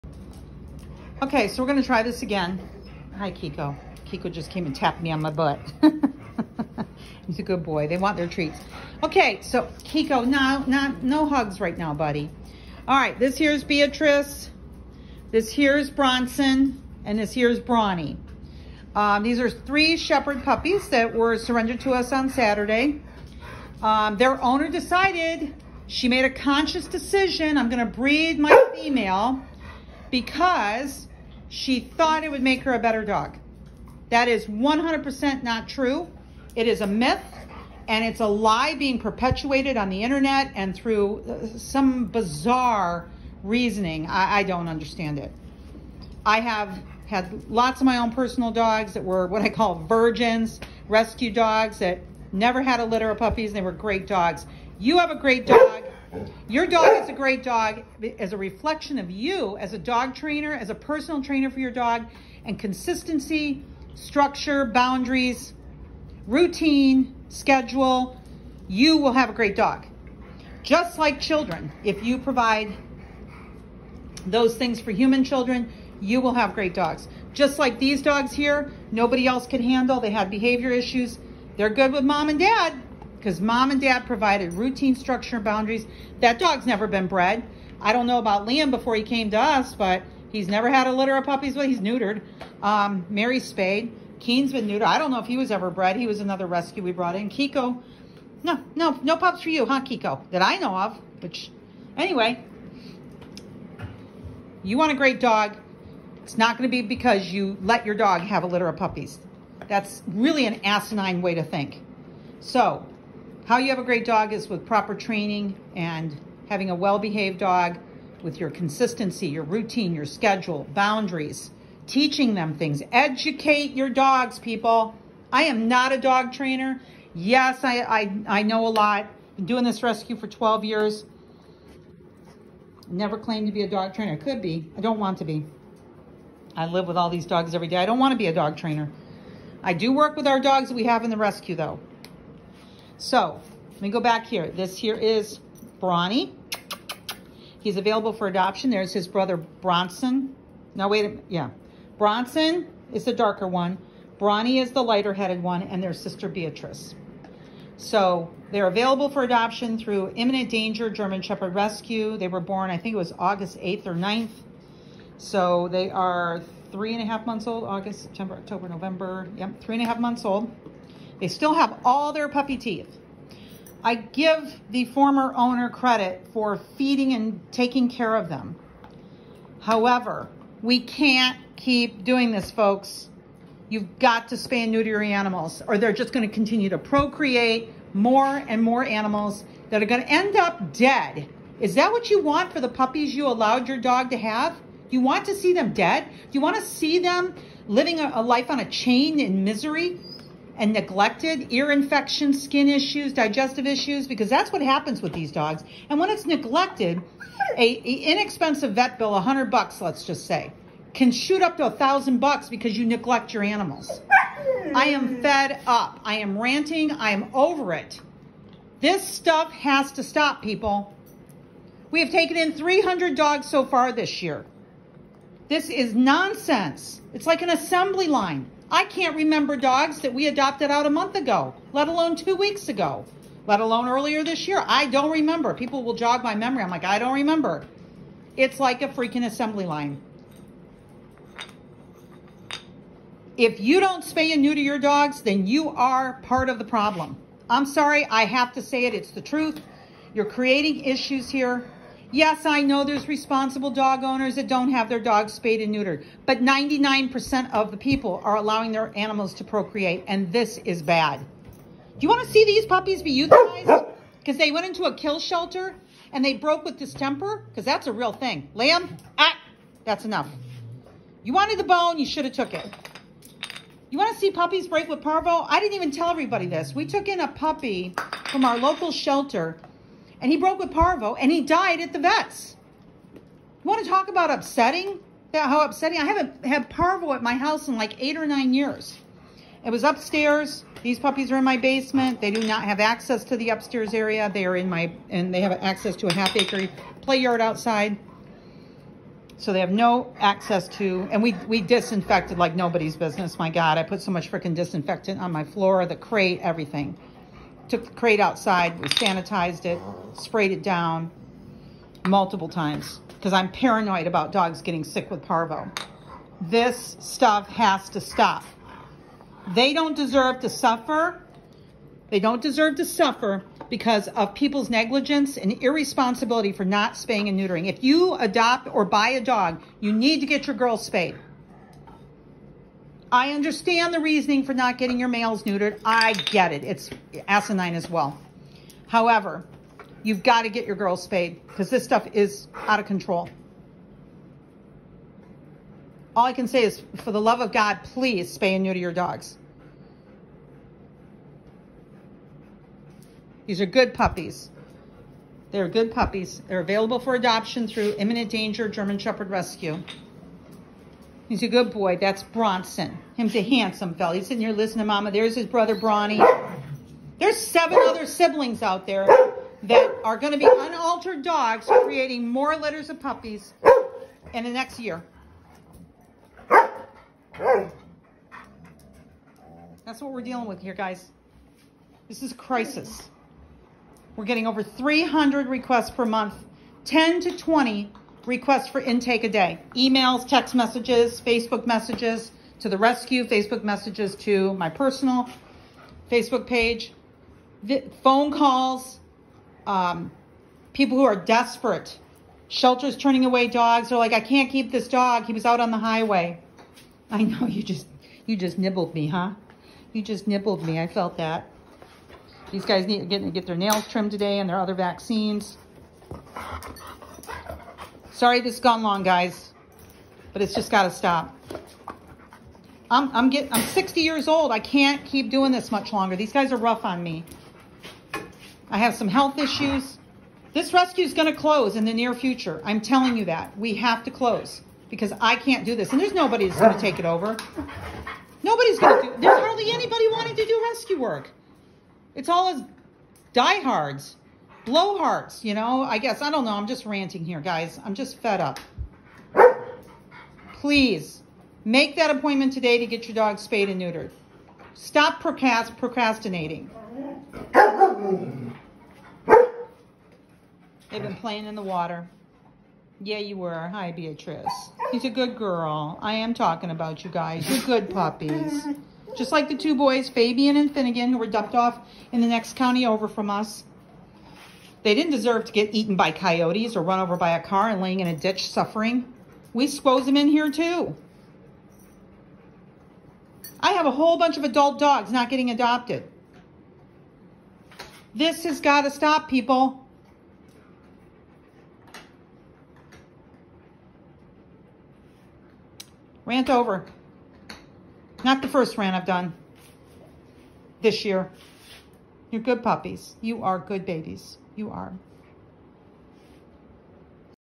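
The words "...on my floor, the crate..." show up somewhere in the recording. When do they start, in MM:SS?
05:05.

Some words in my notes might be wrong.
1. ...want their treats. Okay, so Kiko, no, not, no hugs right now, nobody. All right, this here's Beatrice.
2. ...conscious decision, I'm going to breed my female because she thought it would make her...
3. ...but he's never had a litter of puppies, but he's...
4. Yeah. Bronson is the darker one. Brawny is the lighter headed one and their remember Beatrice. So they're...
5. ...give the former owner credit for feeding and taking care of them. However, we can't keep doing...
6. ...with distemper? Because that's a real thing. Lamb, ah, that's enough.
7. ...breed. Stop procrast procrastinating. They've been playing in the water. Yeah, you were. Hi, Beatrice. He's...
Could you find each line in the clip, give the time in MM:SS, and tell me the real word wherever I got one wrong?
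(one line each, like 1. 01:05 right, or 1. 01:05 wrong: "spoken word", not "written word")
1. 00:07 wrong: "buddy", not "nobody"
2. 00:26 right
3. 01:29 right
4. 02:31 wrong: "sister", not "remember"
5. 02:53 right
6. 04:26 right
7. 07:33 wrong: "neutered", not "breed".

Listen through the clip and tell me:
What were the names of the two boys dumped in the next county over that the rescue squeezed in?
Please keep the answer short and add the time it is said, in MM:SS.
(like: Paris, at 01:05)
Fabian and Finnegan, at 07:50.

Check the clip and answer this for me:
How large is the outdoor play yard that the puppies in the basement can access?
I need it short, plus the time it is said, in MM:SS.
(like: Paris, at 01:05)
Half acre, at 04:56.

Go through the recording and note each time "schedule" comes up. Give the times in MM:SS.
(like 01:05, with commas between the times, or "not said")
01:07, 02:00.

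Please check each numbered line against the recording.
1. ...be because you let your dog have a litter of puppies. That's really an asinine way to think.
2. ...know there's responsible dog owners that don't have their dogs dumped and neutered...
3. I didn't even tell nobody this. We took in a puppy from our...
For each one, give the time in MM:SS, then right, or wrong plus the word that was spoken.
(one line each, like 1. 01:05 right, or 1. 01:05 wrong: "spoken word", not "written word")
1. 01:46 right
2. 04:12 wrong: "spayed", not "dumped"
3. 04:35 wrong: "everybody", not "nobody".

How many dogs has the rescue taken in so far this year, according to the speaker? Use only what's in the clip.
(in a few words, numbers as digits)
300.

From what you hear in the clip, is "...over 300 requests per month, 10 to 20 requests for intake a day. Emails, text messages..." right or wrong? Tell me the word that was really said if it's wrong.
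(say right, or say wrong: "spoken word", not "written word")
right.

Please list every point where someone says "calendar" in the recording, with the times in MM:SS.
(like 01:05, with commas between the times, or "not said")
not said.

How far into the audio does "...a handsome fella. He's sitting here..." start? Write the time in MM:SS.
06:03.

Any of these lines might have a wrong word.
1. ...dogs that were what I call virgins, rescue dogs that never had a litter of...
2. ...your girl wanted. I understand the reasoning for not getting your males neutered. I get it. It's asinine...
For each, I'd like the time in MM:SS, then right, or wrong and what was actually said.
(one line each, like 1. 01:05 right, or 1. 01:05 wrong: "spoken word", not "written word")
1. 00:48 right
2. 05:30 wrong: "spayed", not "wanted".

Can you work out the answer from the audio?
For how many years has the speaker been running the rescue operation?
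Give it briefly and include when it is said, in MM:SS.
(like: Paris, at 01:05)
12, at 02:10.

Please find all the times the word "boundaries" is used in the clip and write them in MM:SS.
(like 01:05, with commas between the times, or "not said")
01:04, 01:25, 02:00.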